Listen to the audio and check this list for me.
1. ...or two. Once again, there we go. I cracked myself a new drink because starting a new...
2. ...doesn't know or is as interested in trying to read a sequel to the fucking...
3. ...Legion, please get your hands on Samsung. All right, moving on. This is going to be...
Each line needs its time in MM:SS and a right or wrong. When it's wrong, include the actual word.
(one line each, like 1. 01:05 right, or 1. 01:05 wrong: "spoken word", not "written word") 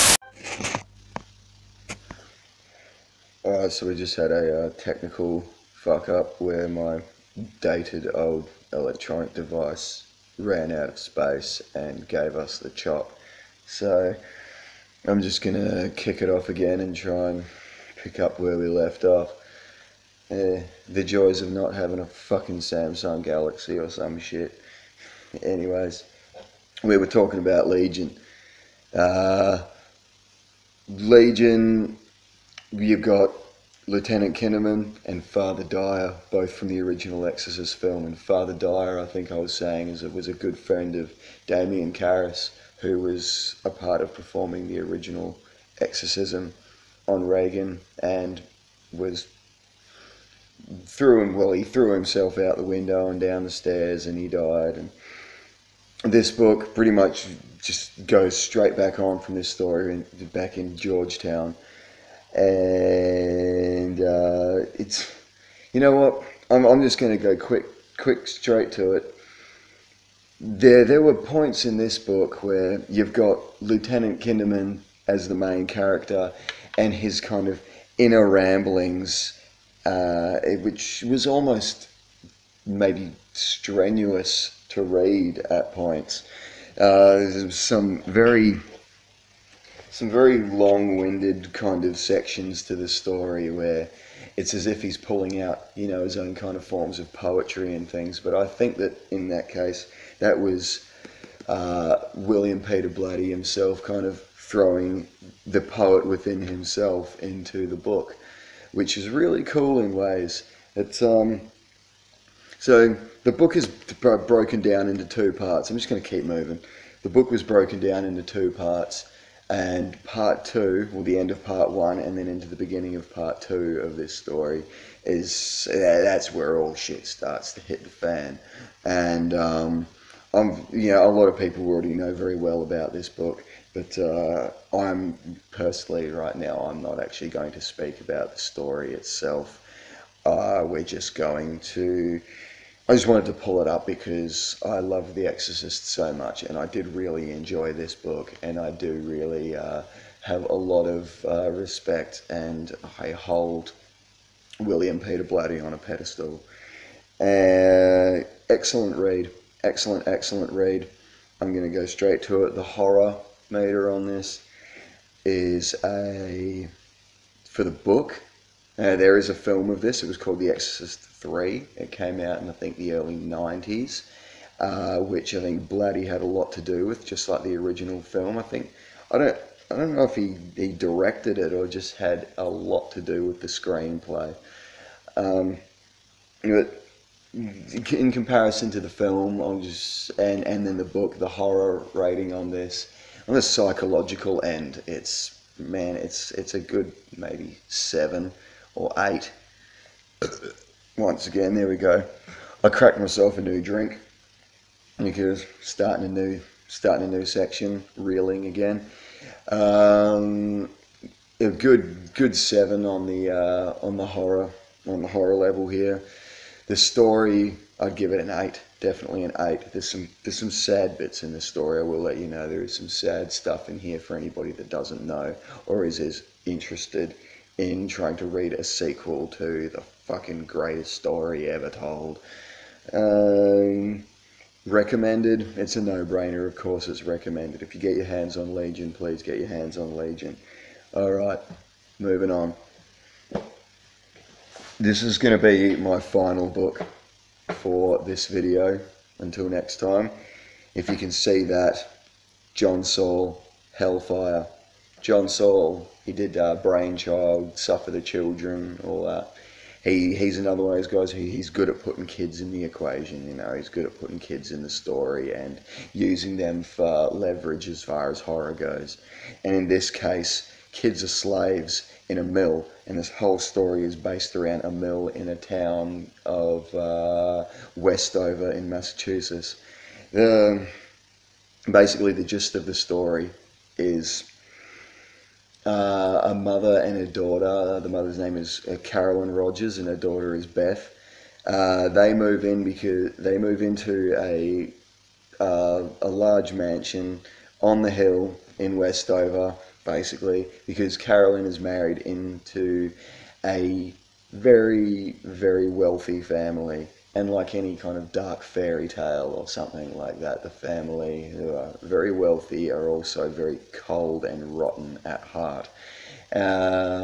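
1. 03:18 wrong: "eight", not "two"
2. 03:44 right
3. 03:58 wrong: "Legion", not "Samsung".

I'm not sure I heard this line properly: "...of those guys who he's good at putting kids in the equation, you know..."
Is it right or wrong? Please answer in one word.
right.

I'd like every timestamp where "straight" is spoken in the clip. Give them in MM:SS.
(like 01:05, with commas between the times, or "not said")
00:58, 01:08, 02:41.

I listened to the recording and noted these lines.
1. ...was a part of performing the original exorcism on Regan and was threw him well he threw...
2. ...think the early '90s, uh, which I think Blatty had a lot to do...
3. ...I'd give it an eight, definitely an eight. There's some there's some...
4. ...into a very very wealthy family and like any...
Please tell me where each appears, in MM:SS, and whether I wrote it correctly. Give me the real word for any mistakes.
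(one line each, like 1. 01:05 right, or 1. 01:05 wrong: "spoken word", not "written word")
1. 00:42 right
2. 02:52 right
3. 03:37 right
4. 05:01 right.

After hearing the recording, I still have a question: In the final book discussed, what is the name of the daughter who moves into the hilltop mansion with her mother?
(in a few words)
Beth.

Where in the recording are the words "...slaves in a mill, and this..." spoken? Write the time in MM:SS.
04:31.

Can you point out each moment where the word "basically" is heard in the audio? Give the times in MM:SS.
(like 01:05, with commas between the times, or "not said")
04:41, 04:59.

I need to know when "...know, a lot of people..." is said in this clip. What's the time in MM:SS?
02:10.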